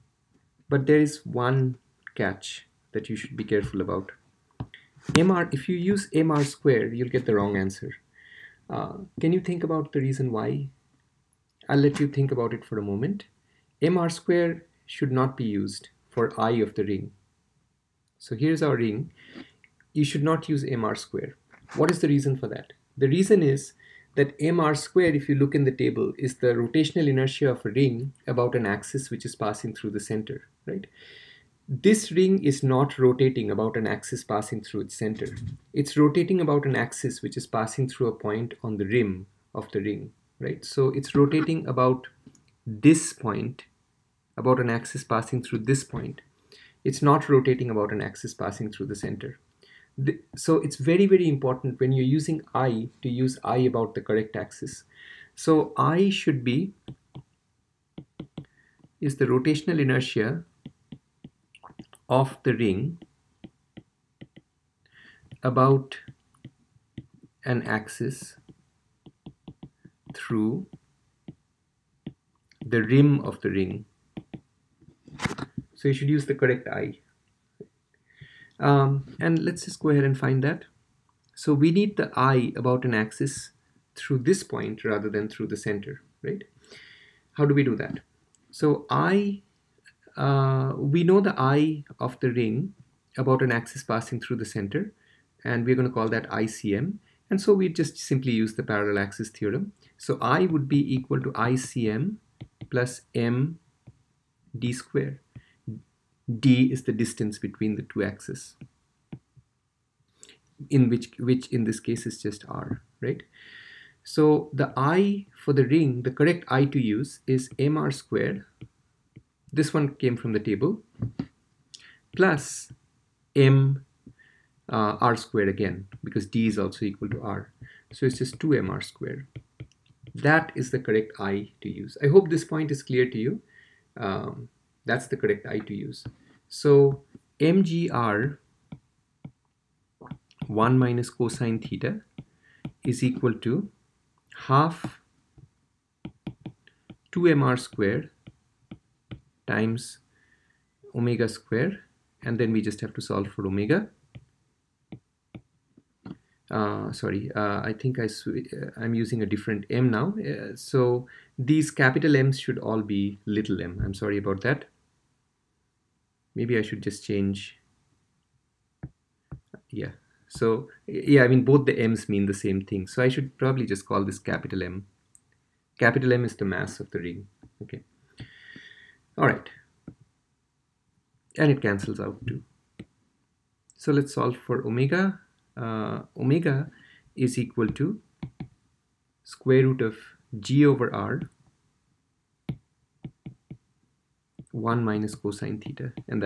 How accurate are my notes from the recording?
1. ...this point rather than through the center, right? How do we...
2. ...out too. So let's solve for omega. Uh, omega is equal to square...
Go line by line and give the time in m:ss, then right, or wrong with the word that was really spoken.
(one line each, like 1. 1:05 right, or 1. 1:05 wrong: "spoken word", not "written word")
1. 1:24 right
2. 3:01 right.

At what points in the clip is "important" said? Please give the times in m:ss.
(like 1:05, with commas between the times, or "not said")
0:51.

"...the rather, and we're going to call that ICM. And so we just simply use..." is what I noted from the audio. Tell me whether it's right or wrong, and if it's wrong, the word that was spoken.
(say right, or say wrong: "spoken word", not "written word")
wrong: "center", not "rather".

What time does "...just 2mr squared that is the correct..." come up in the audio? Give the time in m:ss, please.
2:08.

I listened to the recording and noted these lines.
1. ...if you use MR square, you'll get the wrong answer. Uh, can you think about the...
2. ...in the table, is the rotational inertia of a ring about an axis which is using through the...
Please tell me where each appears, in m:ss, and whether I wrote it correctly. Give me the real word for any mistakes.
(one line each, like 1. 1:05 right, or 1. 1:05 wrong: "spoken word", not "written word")
1. 0:05 right
2. 0:25 wrong: "passing", not "using".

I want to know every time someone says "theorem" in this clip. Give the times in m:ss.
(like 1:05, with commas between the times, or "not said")
1:39.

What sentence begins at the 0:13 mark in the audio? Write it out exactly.
MR square should not be used for I of the ring.